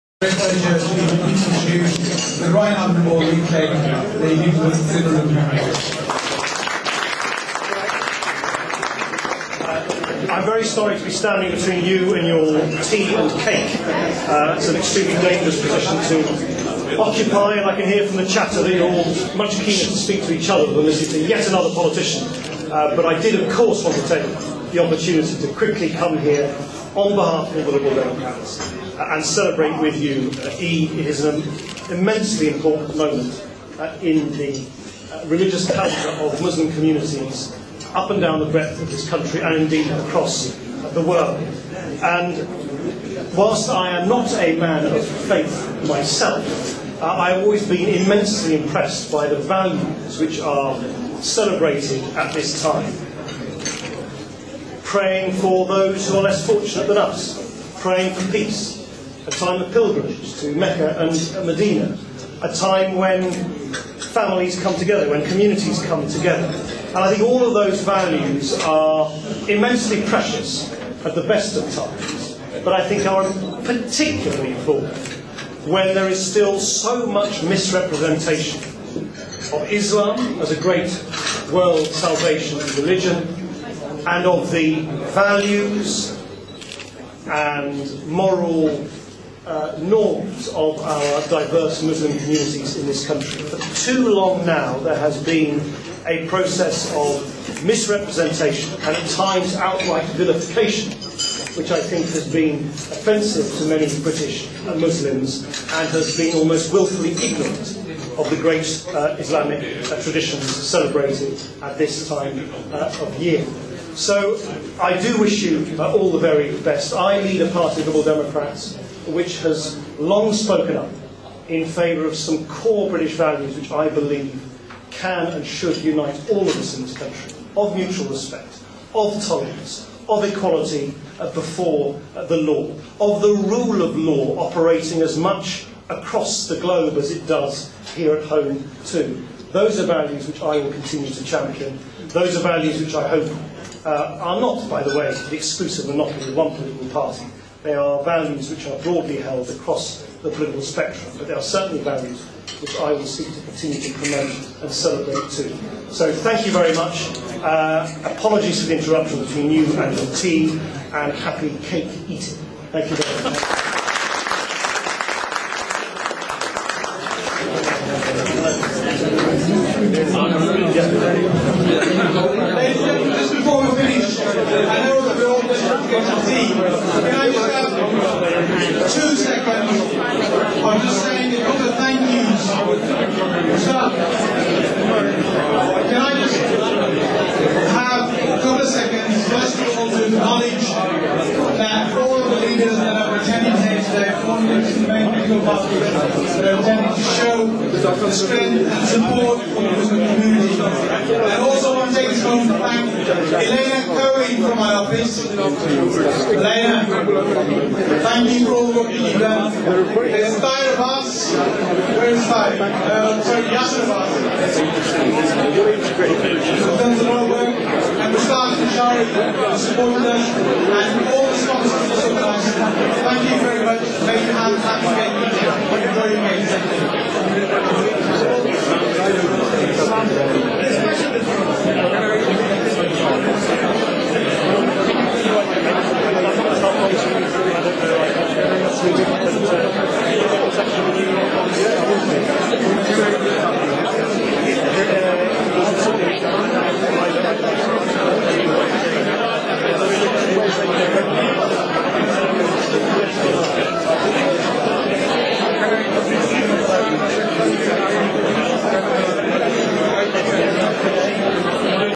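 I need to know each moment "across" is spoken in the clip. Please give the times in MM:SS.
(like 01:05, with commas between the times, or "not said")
00:39, 02:15, 02:29.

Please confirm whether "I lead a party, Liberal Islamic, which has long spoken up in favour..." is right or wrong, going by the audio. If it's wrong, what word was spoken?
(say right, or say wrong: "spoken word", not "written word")
wrong: "Democrats", not "Islamic".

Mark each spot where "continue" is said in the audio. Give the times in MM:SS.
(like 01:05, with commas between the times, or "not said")
02:20, 02:33.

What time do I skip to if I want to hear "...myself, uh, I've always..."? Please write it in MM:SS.
00:45.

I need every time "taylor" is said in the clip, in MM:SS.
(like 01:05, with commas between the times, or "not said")
not said.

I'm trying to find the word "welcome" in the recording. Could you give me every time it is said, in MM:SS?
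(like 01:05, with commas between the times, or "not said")
not said.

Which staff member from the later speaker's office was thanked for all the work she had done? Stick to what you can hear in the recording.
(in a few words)
Elena Cohen.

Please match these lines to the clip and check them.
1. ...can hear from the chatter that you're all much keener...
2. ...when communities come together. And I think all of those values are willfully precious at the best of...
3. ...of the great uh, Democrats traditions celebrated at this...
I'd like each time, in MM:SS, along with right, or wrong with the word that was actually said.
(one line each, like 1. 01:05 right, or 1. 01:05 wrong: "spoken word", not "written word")
1. 00:17 right
2. 01:05 wrong: "immensely", not "willfully"
3. 01:48 wrong: "Islamic", not "Democrats".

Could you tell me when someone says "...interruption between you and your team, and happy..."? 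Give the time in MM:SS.
02:38.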